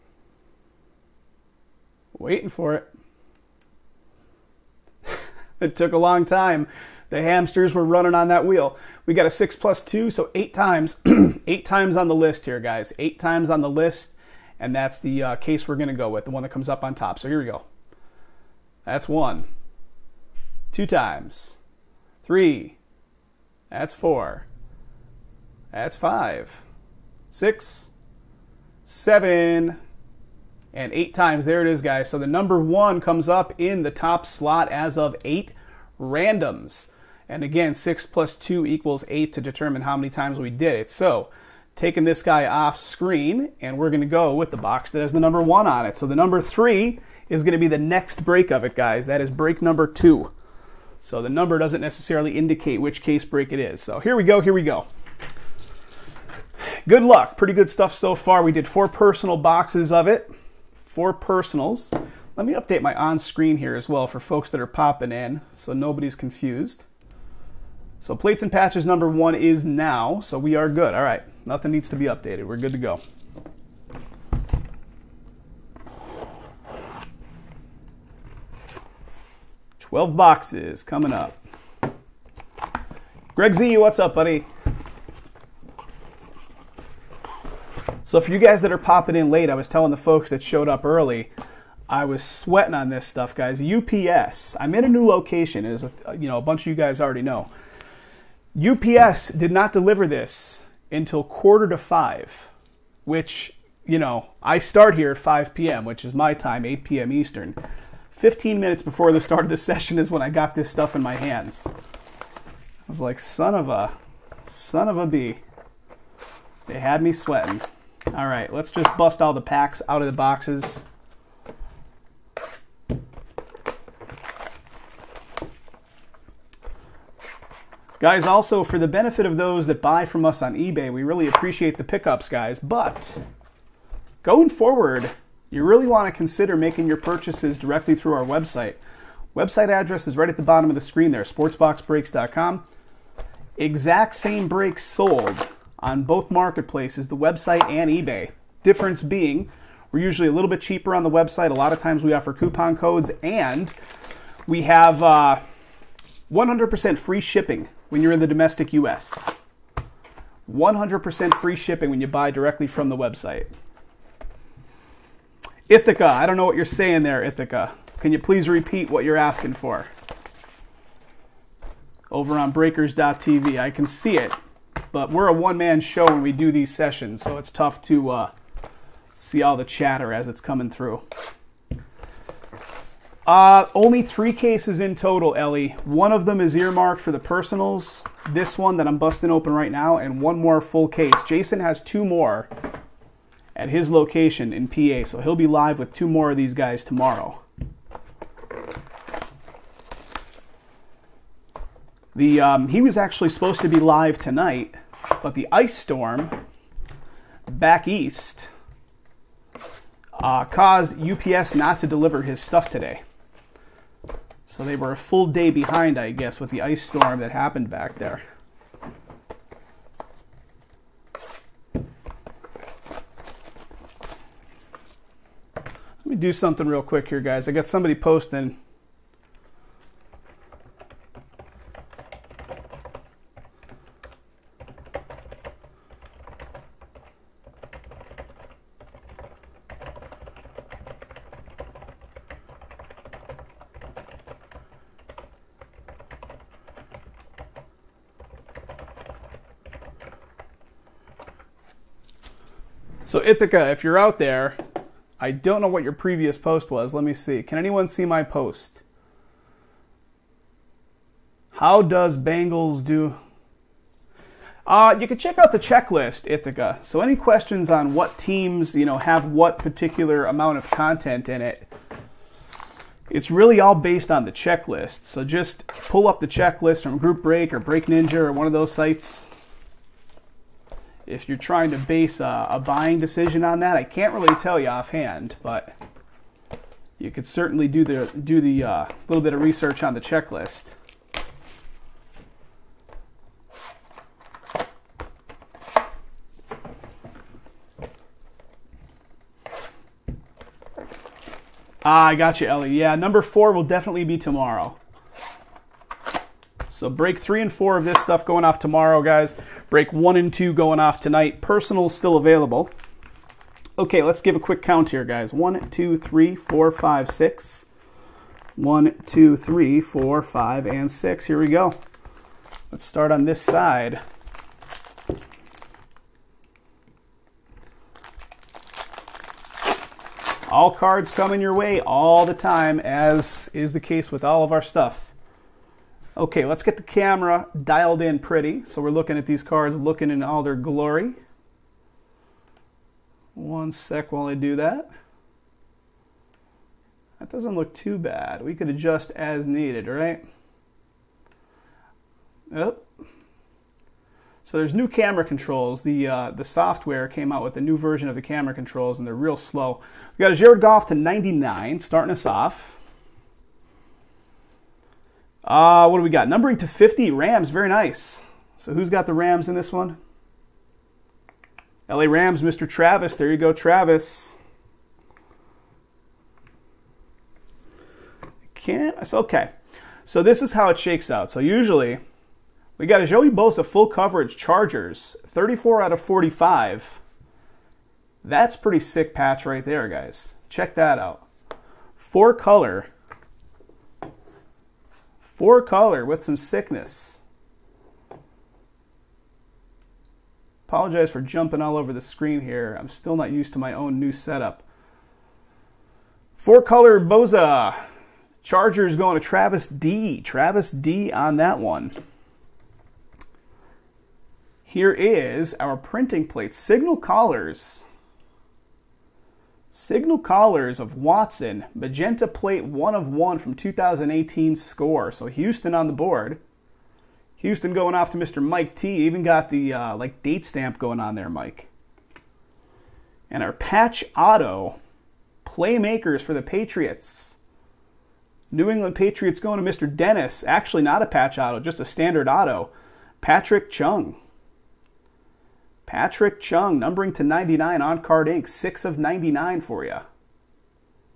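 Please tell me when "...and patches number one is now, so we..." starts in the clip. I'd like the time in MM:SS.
01:08.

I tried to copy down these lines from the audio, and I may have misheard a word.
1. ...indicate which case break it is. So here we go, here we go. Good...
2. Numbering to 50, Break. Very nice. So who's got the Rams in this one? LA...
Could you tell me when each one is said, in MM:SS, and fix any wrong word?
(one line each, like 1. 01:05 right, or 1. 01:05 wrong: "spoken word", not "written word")
1. 00:52 right
2. 06:06 wrong: "Rams", not "Break".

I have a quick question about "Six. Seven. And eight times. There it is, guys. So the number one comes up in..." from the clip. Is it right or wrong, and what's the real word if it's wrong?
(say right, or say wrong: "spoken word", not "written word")
right.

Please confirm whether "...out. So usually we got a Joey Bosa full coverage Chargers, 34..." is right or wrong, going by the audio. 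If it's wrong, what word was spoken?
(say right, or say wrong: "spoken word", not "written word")
right.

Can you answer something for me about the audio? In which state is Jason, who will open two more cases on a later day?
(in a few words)
PA.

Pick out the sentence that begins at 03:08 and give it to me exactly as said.
This one that I'm busting open right now, and one more full case.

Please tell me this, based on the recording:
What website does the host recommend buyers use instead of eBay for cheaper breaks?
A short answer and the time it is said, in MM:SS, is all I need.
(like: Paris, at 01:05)
sportsboxbreaks.com, at 02:21.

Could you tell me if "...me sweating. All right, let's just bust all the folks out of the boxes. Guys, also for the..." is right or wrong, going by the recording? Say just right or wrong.
wrong.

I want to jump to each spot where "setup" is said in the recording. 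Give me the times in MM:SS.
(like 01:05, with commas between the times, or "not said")
06:44.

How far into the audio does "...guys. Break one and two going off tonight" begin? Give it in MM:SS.
05:09.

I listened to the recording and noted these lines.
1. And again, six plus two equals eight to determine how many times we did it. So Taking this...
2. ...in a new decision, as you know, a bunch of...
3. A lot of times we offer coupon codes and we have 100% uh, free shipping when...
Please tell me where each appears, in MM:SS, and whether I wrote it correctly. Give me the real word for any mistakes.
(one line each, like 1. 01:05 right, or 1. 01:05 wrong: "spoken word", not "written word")
1. 00:37 right
2. 01:34 wrong: "location", not "decision"
3. 02:31 right.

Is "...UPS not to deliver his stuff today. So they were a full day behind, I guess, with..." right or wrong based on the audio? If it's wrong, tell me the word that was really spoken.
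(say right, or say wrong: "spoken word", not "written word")
right.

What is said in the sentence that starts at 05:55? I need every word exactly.
The uh, the software came out with a new version of the camera controls, and they're real slow.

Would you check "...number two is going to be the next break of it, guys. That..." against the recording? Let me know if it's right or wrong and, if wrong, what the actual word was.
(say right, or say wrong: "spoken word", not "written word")
wrong: "three", not "two".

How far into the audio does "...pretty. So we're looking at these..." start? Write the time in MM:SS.
05:38.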